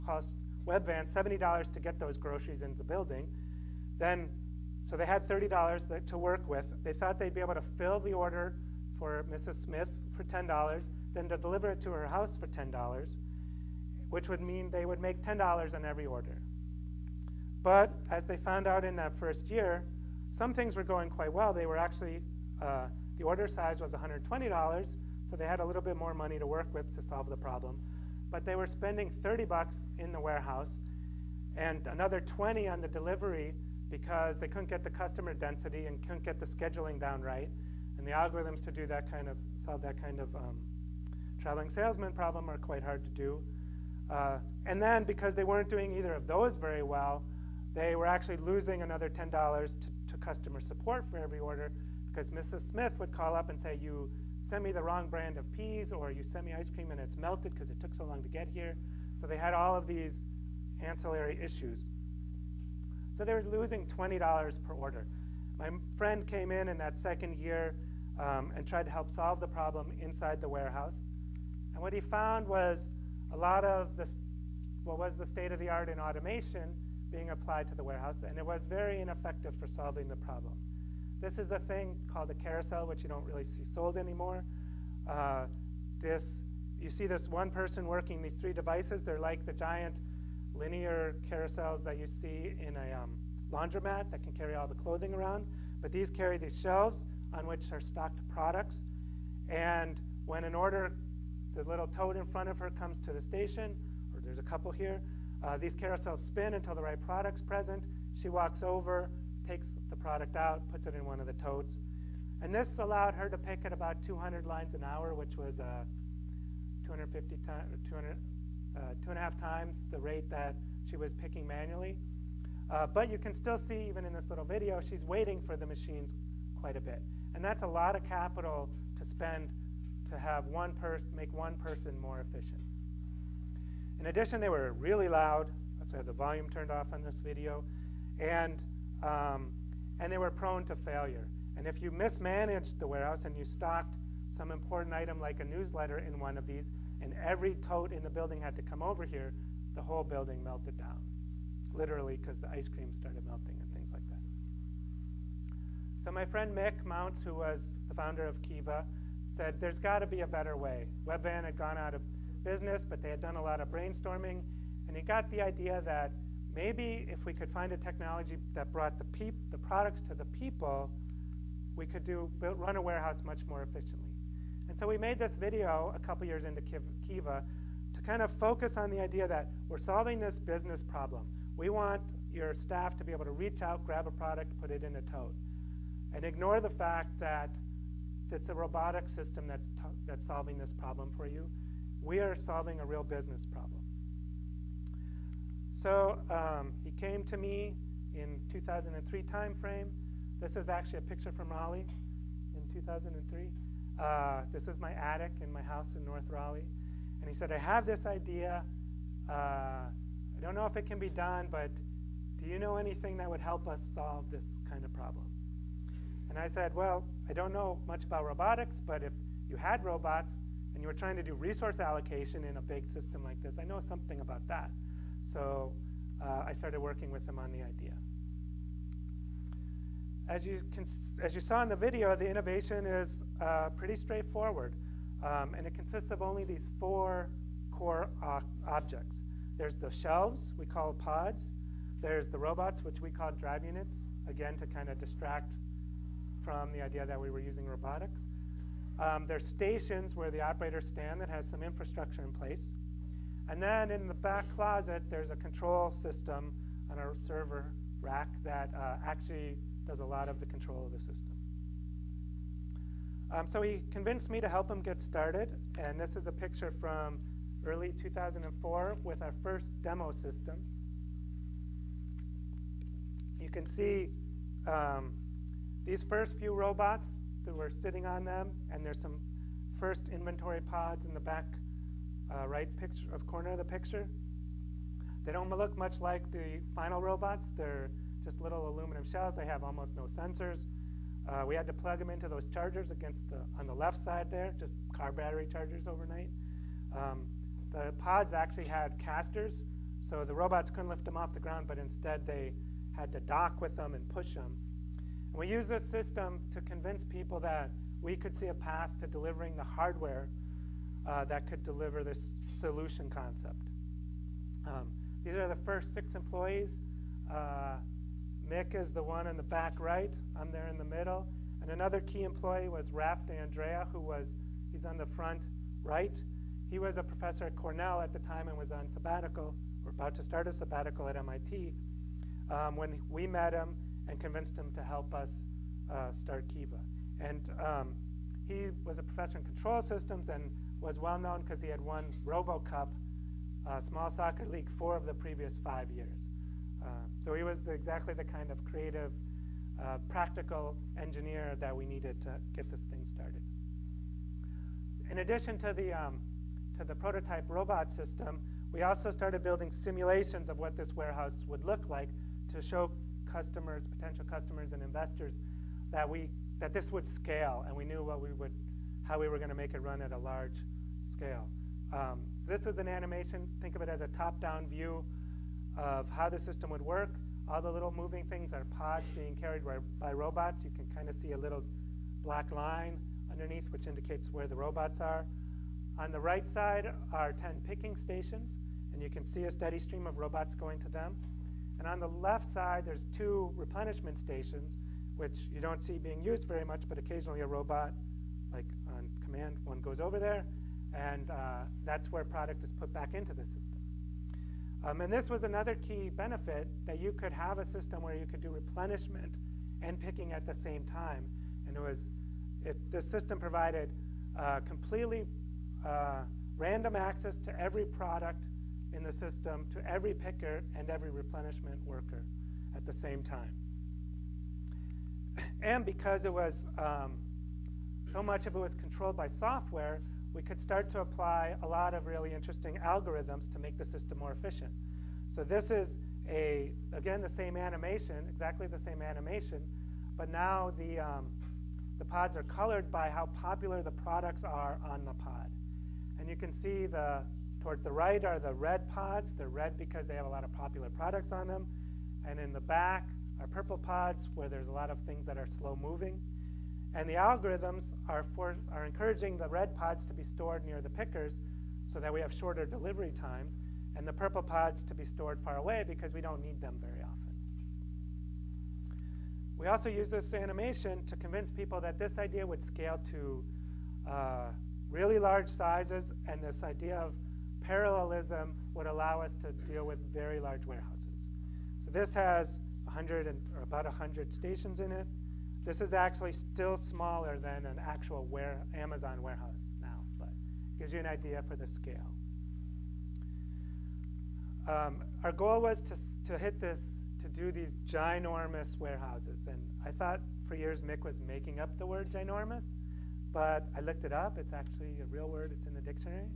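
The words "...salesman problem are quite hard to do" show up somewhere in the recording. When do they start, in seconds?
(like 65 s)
41 s.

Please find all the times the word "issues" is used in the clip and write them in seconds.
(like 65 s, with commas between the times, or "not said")
61 s.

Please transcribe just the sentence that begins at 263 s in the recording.
Um, so he convinced me to help him get started.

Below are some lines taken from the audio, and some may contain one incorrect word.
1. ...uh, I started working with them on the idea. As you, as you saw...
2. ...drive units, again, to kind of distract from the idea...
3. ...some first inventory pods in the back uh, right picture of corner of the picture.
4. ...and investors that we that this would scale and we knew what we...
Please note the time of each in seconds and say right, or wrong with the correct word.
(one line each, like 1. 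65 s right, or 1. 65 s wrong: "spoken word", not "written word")
1. 226 s right
2. 243 s right
3. 278 s right
4. 364 s right.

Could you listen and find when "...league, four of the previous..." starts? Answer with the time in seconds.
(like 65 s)
344 s.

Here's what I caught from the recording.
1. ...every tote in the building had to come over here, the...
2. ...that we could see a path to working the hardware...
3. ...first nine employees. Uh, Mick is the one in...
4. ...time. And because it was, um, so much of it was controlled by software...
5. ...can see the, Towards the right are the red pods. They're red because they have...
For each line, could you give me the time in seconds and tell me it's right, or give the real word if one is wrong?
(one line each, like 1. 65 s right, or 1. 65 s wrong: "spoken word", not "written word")
1. 147 s right
2. 307 s wrong: "delivering", not "working"
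3. 315 s wrong: "six", not "nine"
4. 423 s right
5. 446 s right.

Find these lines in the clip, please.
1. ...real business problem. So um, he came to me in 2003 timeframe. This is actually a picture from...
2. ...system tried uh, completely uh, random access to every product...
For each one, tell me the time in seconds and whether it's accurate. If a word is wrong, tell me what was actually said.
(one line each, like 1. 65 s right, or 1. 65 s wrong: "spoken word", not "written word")
1. 192 s right
2. 413 s wrong: "provided", not "tried".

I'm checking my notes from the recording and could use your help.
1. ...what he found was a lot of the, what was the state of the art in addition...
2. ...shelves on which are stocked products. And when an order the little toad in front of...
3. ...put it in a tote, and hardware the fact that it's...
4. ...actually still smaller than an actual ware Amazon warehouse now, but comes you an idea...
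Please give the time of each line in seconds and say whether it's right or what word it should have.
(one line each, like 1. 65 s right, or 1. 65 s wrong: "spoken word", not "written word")
1. 71 s wrong: "automation", not "addition"
2. 96 s right
3. 184 s wrong: "ignore", not "hardware"
4. 485 s wrong: "gives", not "comes".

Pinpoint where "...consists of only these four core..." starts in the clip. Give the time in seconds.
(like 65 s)
235 s.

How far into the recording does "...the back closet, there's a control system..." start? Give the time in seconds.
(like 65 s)
254 s.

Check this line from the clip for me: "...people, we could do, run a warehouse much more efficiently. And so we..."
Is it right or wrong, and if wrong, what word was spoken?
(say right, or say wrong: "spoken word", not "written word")
right.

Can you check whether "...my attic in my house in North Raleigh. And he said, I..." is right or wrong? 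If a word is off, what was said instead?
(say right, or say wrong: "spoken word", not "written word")
right.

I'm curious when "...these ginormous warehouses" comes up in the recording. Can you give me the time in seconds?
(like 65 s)
497 s.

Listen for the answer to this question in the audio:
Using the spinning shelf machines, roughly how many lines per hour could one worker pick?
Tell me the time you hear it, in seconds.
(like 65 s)
114 s.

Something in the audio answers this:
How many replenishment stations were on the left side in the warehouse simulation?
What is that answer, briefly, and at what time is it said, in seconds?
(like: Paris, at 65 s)
2, at 393 s.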